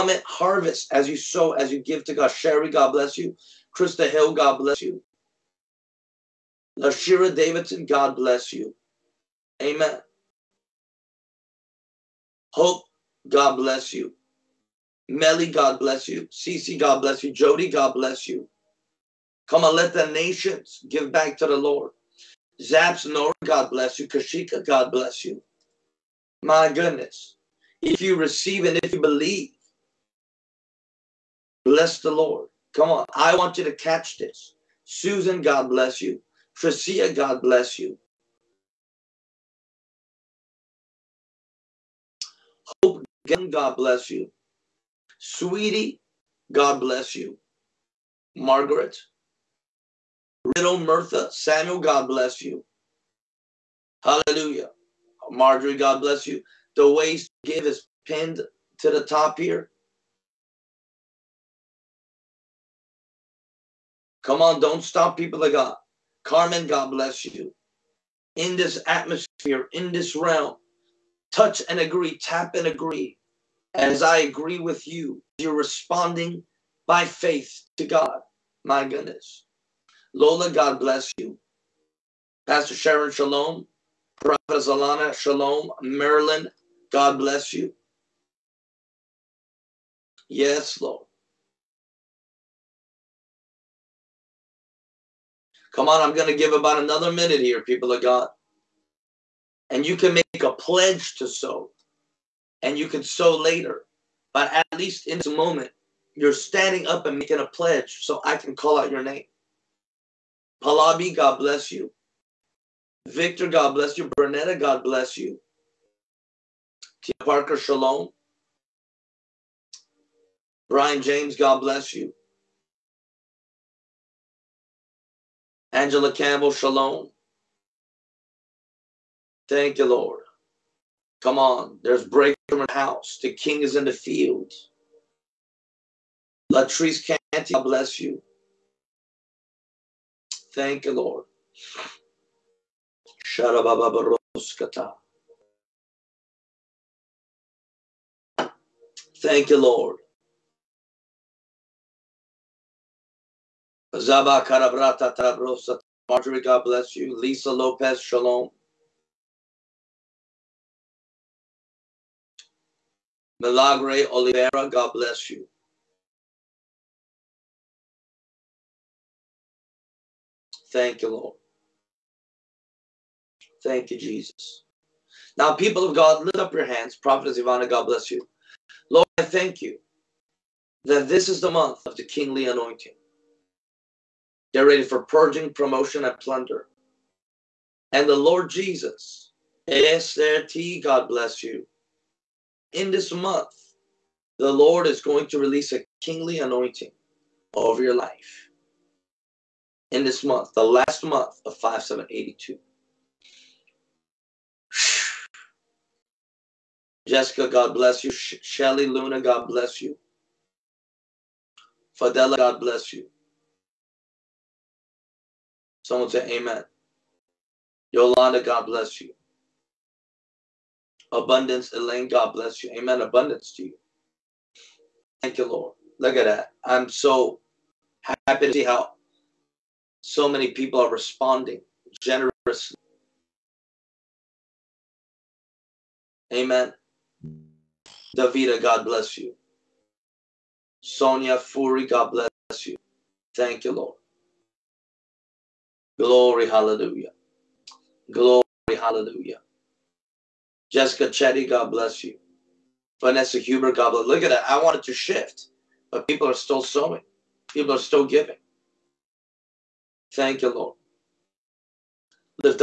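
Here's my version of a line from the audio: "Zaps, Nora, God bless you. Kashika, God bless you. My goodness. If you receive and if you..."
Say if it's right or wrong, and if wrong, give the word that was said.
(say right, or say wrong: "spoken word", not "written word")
right.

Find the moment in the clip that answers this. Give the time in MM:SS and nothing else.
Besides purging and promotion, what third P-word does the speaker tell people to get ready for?
03:06.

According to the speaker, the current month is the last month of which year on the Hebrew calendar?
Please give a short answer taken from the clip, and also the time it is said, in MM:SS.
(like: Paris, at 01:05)
5782, at 03:21.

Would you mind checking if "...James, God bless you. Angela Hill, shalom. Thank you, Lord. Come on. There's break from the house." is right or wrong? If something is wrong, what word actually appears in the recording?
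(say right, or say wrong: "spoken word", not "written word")
wrong: "Campbell", not "Hill".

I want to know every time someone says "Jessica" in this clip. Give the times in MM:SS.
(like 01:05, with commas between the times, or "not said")
03:27, 04:10.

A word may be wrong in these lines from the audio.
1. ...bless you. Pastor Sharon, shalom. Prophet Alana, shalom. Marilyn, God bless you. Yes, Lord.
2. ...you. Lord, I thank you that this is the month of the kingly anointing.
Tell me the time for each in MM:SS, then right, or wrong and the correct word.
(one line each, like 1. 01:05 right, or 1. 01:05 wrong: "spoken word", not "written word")
1. 01:20 right
2. 02:58 right.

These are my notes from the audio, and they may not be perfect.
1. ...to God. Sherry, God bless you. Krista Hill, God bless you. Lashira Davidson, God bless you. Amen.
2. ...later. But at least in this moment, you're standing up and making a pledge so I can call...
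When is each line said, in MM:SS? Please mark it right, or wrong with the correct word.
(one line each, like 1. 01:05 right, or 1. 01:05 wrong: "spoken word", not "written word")
1. 00:02 right
2. 01:43 right.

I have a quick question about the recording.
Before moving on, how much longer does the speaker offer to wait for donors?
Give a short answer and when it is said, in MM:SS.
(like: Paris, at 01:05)
About another minute, at 01:36.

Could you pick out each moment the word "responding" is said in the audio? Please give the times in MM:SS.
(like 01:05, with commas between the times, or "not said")
01:15, 03:50.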